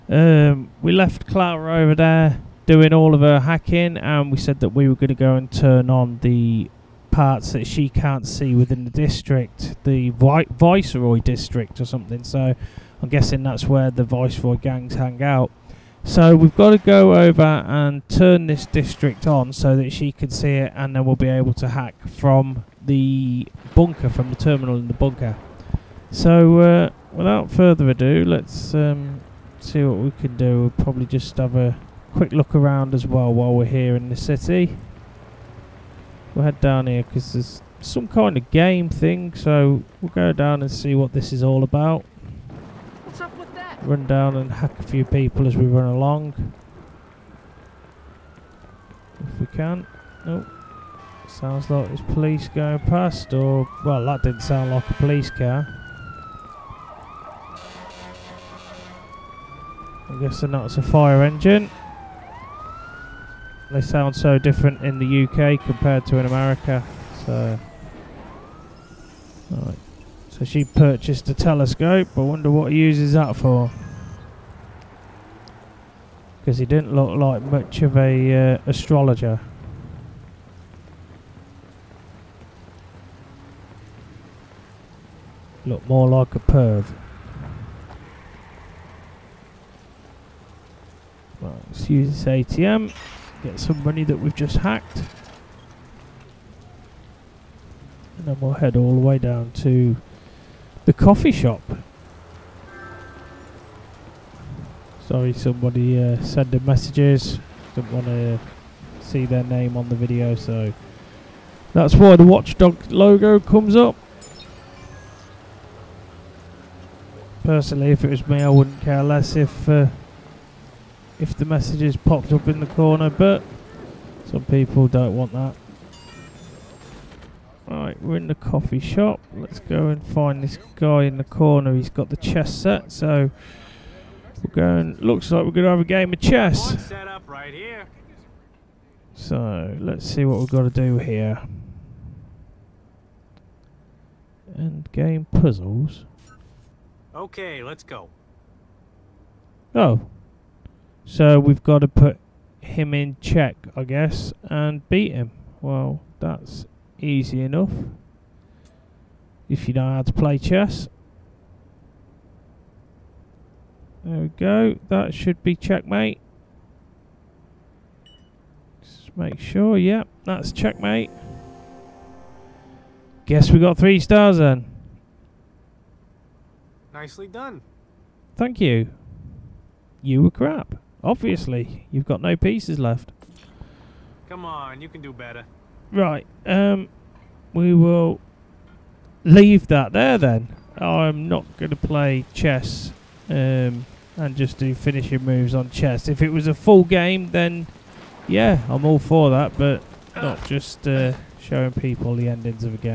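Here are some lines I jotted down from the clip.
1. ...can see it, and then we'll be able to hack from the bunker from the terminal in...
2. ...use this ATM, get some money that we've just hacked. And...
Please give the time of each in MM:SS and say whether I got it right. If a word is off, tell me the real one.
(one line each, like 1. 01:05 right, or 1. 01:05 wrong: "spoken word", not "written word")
1. 00:20 right
2. 01:31 right.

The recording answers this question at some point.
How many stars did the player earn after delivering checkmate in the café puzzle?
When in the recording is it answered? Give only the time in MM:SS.
02:53.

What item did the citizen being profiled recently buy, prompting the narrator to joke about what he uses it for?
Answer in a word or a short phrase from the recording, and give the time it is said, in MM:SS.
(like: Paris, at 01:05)
Telescope, at 01:11.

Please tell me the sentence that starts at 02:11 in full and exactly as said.
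He's got the chess set, so we're going.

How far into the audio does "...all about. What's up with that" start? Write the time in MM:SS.
00:41.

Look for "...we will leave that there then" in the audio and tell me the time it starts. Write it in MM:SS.
03:07.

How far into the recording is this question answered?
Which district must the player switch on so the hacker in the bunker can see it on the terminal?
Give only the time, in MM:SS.
00:10.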